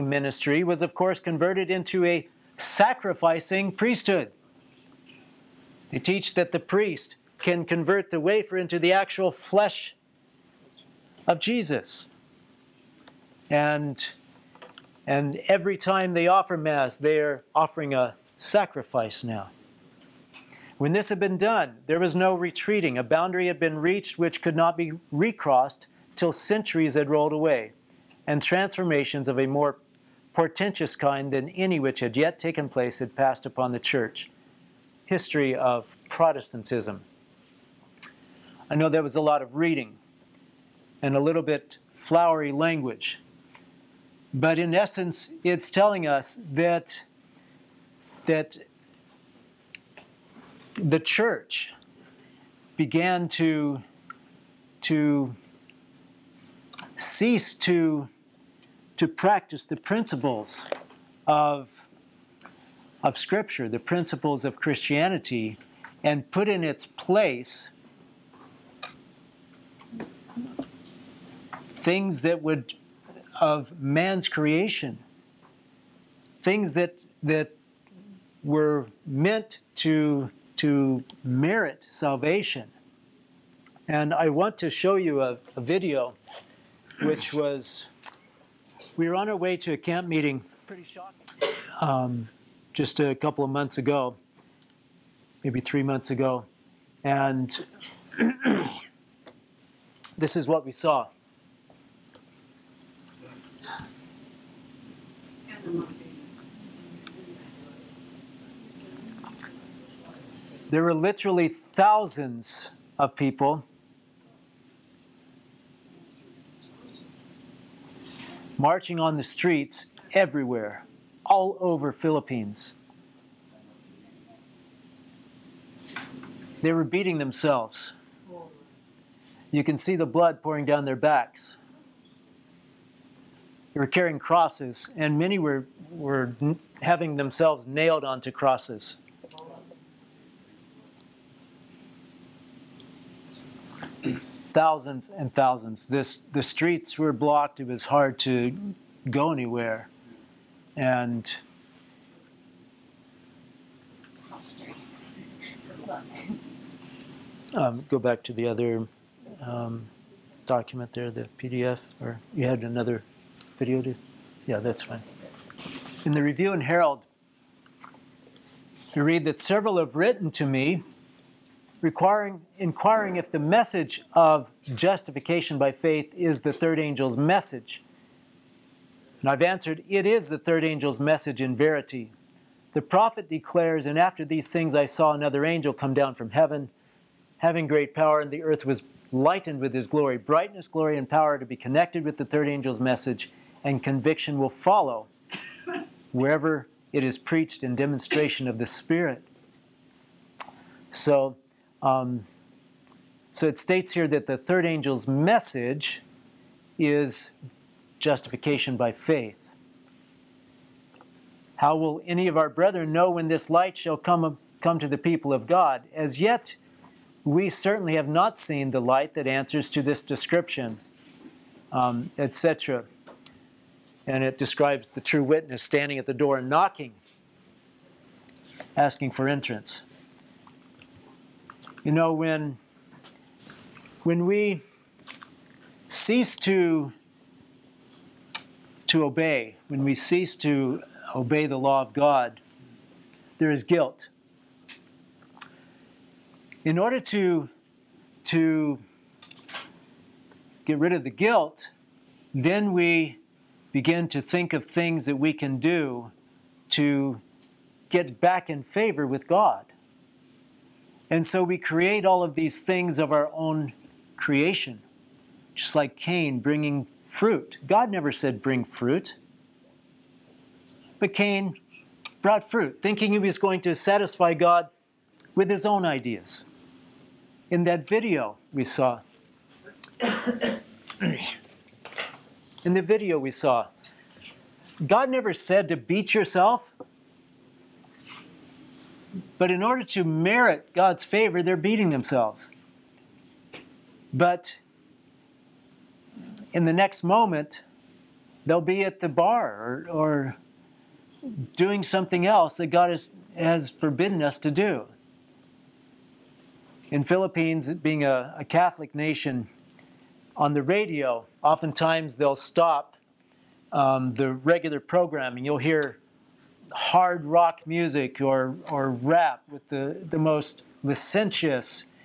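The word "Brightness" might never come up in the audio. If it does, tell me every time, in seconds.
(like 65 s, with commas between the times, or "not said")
190 s.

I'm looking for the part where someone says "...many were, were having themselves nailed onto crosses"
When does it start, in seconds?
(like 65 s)
135 s.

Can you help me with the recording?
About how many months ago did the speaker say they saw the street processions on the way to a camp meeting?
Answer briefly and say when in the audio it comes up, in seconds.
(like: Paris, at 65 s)
3, at 95 s.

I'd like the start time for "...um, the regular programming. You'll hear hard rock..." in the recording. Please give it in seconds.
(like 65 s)
313 s.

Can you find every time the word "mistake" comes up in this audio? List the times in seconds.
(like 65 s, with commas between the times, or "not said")
not said.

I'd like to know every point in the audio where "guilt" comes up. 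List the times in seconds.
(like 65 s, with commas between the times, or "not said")
243 s, 251 s.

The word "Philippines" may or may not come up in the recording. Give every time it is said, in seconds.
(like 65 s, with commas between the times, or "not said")
121 s, 307 s.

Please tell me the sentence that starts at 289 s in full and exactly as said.
But in order to merit God's favor, they're beating themselves.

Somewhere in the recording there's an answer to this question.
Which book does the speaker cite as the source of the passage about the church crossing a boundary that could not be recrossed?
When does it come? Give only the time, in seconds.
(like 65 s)
35 s.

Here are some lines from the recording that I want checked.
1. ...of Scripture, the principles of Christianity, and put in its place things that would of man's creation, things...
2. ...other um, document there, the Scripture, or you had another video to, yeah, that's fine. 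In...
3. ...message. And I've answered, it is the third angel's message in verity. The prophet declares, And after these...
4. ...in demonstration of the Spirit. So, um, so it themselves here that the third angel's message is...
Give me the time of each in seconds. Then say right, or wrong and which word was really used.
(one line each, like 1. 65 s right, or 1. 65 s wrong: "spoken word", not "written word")
1. 63 s right
2. 158 s wrong: "PDF", not "Scripture"
3. 177 s right
4. 197 s wrong: "states", not "themselves".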